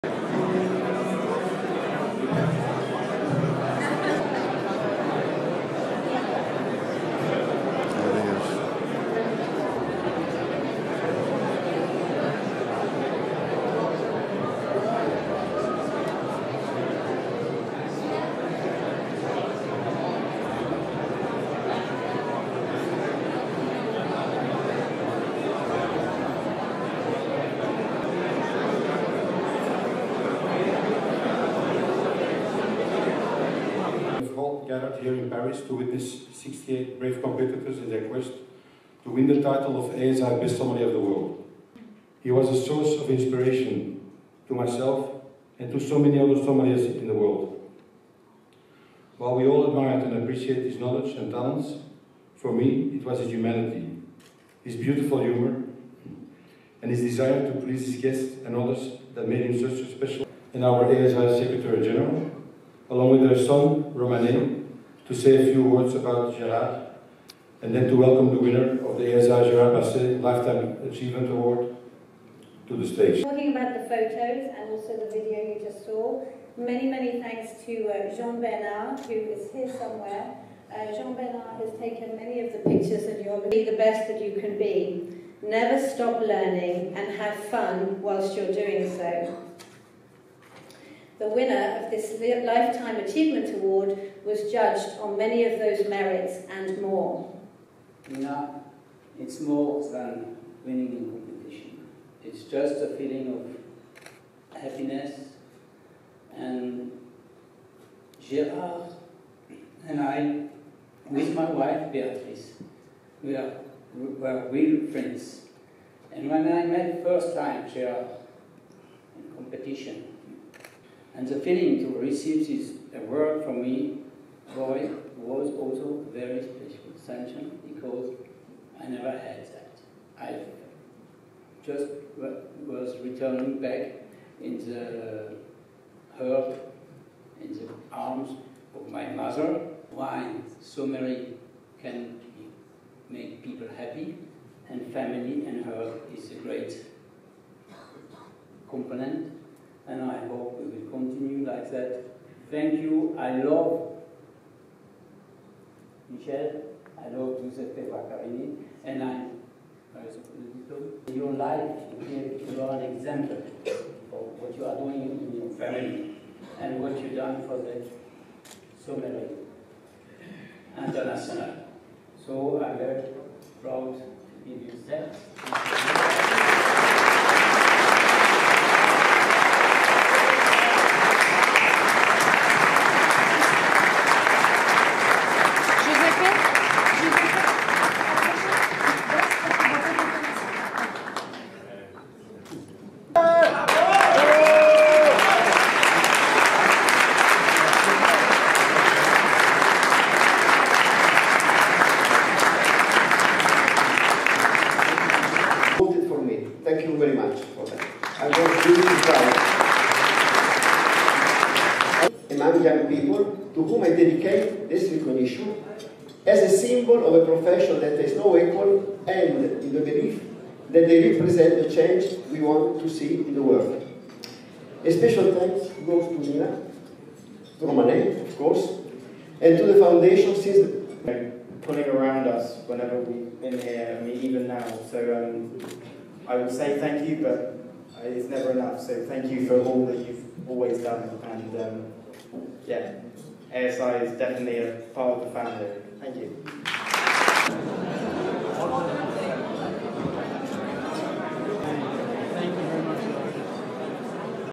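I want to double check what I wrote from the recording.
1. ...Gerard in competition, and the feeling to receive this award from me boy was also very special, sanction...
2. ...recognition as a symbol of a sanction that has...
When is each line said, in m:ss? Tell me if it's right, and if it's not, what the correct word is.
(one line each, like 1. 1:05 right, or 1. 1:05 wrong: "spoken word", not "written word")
1. 1:57 right
2. 3:34 wrong: "profession", not "sanction".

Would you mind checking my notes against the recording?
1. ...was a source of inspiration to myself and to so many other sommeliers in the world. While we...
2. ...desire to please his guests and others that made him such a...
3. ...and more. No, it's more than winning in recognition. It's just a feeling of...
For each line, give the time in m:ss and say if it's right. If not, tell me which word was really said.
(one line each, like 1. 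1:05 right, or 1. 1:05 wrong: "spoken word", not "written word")
1. 0:42 right
2. 0:57 right
3. 1:36 wrong: "competition", not "recognition".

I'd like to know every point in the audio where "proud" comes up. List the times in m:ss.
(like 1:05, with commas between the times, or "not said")
2:53, 3:29.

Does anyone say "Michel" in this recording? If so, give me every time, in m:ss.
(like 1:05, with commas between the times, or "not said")
2:36.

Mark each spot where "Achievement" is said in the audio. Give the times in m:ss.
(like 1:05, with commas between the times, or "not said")
1:10, 1:33.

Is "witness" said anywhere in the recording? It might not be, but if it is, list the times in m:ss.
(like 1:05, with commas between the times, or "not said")
0:35.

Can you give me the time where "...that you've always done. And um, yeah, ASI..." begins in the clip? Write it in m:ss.
3:59.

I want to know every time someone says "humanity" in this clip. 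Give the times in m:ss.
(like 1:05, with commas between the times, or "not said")
0:53.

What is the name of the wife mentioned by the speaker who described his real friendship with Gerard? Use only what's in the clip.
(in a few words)
Beatrice.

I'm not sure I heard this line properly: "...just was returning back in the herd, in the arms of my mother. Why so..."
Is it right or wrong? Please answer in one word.
right.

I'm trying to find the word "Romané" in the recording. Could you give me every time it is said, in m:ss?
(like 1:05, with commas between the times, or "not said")
1:03, 3:47.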